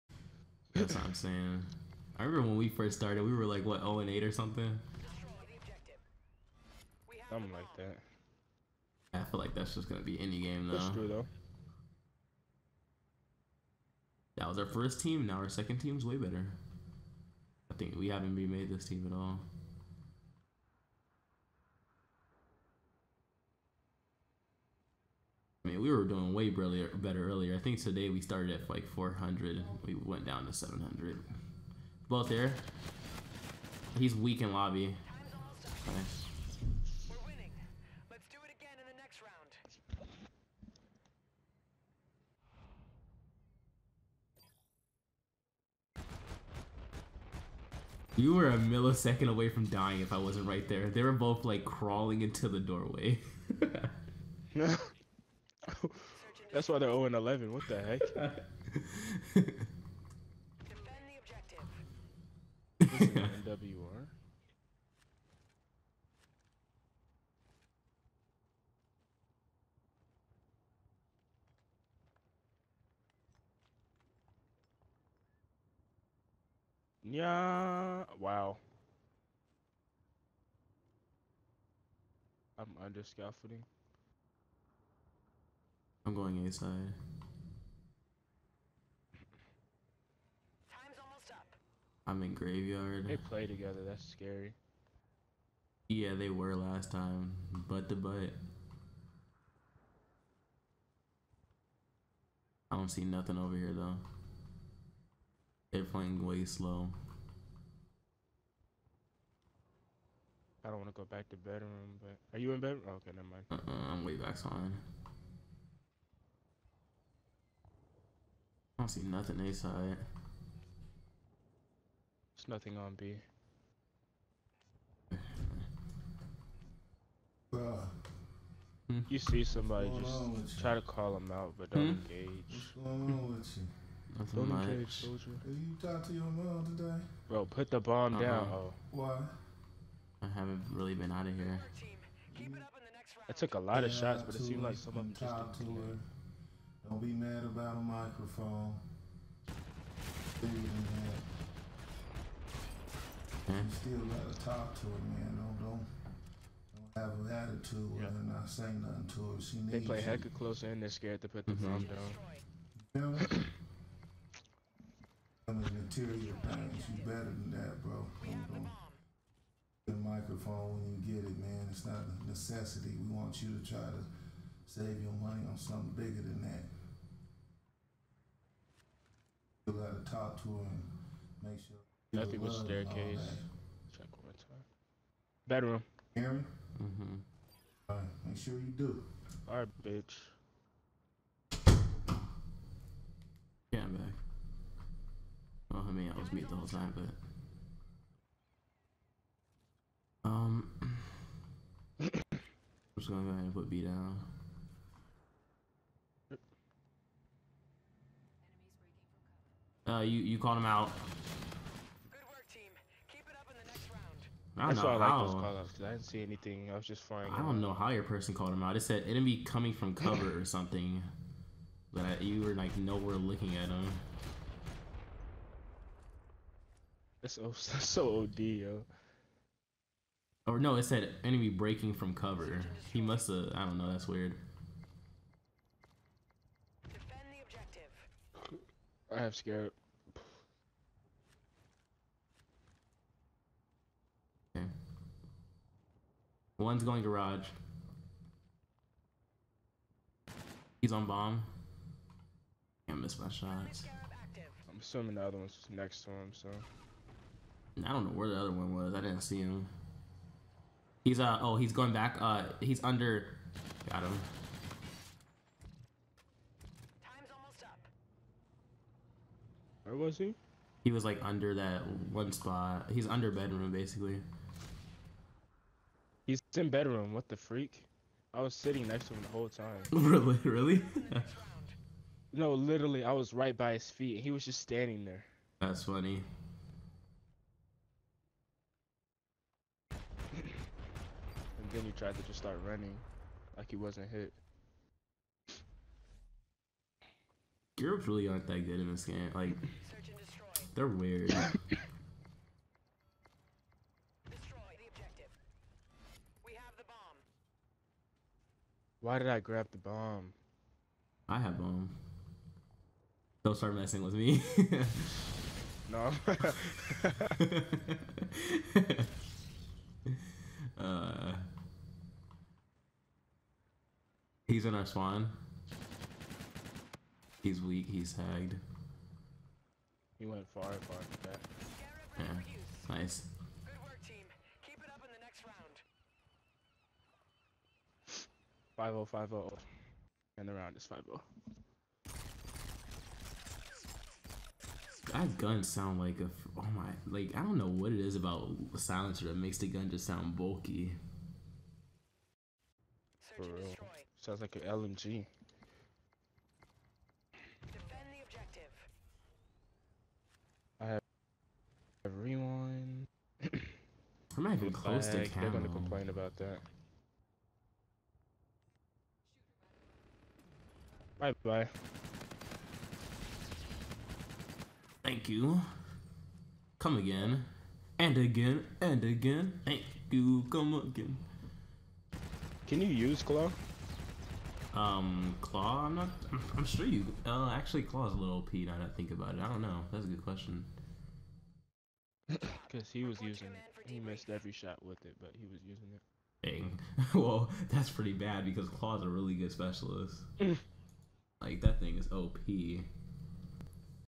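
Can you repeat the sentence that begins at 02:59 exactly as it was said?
You gotta talk to her and make sure.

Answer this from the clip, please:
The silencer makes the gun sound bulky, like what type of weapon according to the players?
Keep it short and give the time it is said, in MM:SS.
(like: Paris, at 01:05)
LMG, at 05:54.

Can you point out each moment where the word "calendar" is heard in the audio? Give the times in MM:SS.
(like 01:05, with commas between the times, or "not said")
not said.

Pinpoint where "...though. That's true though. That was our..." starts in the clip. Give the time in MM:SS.
00:10.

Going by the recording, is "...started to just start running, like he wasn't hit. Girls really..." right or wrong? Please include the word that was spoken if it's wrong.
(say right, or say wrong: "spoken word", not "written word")
wrong: "tried", not "started".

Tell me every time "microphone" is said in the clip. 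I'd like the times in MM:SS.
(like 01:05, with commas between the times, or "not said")
02:27, 02:49.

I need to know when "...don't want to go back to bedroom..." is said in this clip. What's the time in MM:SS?
01:50.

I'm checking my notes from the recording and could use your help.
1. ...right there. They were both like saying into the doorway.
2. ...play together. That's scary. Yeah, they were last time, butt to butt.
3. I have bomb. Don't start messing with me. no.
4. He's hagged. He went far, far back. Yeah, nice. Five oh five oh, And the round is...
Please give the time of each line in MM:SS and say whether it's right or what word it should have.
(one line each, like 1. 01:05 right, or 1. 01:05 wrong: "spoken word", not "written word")
1. 00:50 wrong: "crawling", not "saying"
2. 01:33 right
3. 05:11 right
4. 05:27 right.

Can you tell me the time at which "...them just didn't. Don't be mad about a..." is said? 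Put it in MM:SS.
02:25.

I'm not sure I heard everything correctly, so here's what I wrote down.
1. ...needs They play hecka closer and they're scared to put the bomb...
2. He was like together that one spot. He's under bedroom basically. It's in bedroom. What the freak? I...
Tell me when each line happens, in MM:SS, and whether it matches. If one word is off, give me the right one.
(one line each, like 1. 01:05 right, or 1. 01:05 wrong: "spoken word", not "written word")
1. 02:39 right
2. 04:30 wrong: "under", not "together".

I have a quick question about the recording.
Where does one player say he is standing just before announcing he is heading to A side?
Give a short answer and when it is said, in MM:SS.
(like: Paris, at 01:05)
under scaffolding, at 01:22.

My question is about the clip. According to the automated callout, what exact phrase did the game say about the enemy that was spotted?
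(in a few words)
enemy breaking from cover.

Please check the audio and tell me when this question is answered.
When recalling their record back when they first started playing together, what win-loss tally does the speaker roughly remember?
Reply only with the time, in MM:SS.
00:03.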